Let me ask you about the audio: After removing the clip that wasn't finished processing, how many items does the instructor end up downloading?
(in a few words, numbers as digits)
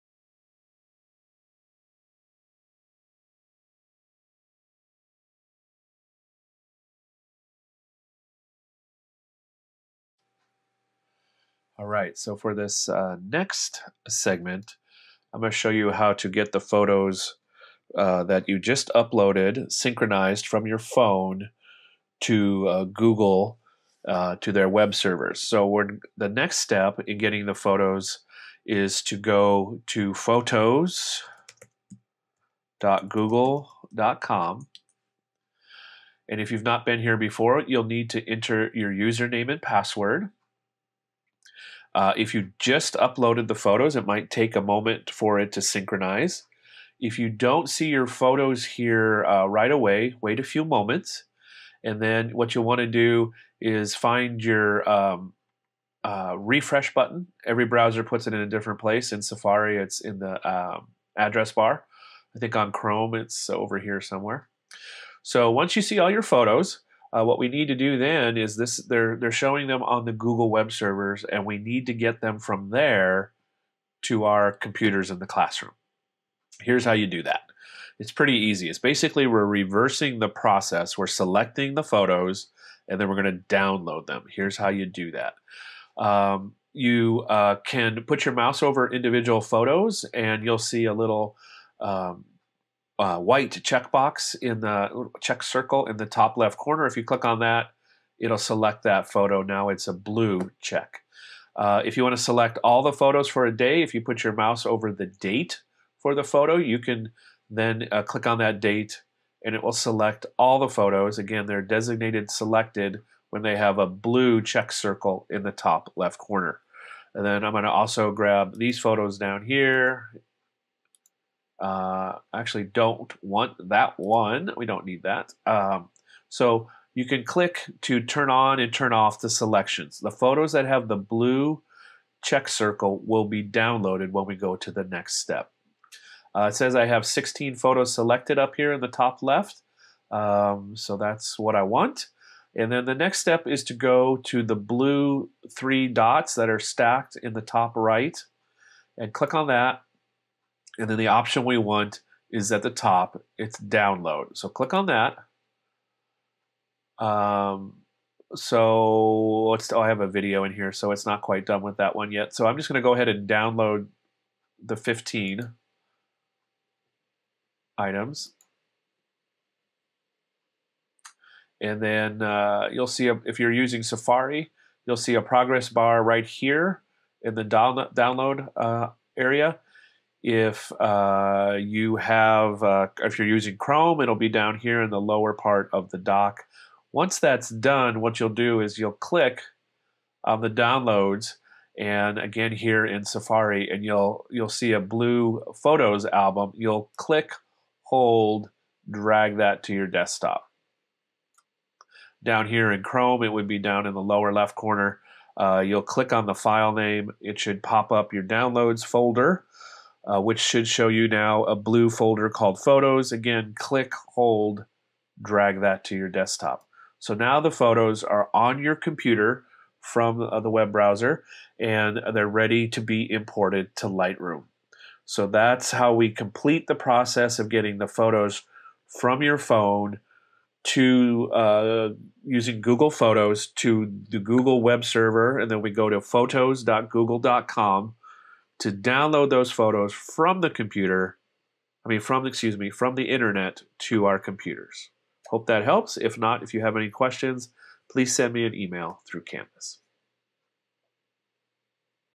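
15.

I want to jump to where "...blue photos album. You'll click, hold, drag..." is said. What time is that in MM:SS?
03:14.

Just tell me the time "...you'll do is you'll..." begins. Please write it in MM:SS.
03:08.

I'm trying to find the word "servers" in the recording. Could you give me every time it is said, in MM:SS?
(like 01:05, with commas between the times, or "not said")
00:24, 01:10, 03:54.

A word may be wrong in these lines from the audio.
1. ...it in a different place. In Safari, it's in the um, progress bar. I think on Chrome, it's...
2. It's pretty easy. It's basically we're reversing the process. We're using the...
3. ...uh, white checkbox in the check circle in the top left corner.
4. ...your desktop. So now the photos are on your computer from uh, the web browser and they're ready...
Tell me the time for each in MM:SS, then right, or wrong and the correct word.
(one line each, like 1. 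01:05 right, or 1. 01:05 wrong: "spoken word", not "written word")
1. 00:58 wrong: "address", not "progress"
2. 01:17 wrong: "selecting", not "using"
3. 01:33 right
4. 03:35 right.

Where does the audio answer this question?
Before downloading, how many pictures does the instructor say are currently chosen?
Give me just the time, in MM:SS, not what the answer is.
02:17.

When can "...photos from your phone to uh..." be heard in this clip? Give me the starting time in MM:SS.
03:47.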